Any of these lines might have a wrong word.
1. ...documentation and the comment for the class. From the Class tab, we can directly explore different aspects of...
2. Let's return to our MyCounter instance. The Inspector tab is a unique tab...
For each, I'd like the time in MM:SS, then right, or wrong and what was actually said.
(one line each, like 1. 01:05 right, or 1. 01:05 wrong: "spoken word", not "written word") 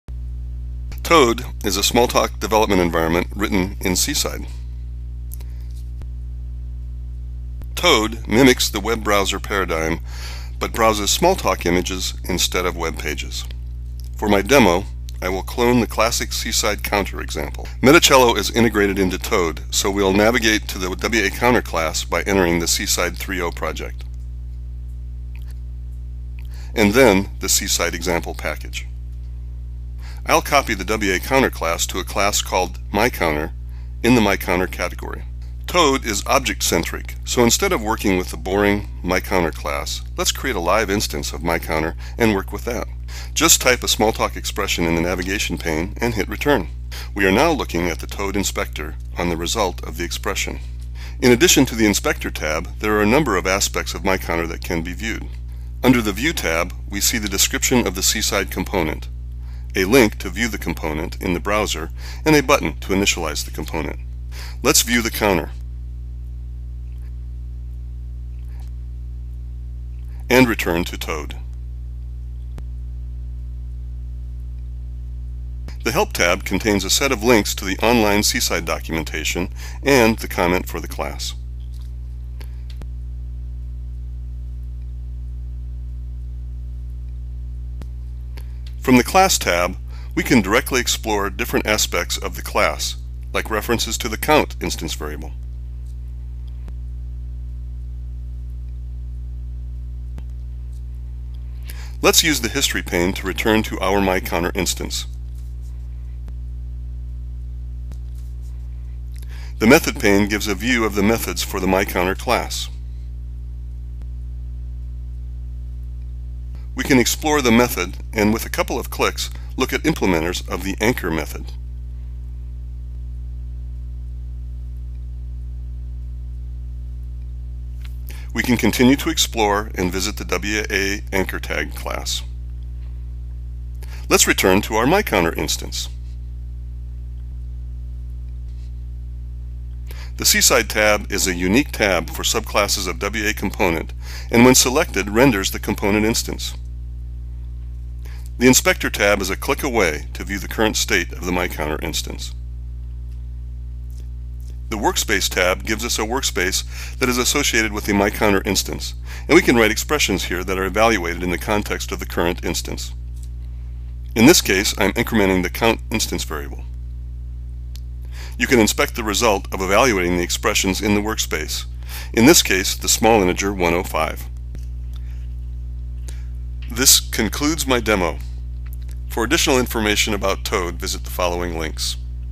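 1. 01:18 right
2. 02:14 wrong: "Seaside", not "Inspector".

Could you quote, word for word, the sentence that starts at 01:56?
We can explore the method and with a couple of clicks look at implementers of the anchor method.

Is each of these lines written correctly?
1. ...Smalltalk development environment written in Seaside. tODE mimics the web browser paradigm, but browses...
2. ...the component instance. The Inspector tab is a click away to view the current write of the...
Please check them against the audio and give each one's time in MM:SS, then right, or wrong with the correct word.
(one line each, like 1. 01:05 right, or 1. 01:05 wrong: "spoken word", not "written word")
1. 00:01 right
2. 02:25 wrong: "state", not "write".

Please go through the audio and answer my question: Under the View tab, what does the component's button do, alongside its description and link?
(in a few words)
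initialize the component.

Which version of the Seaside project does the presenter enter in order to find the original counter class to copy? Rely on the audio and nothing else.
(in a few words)
Seaside 3.0.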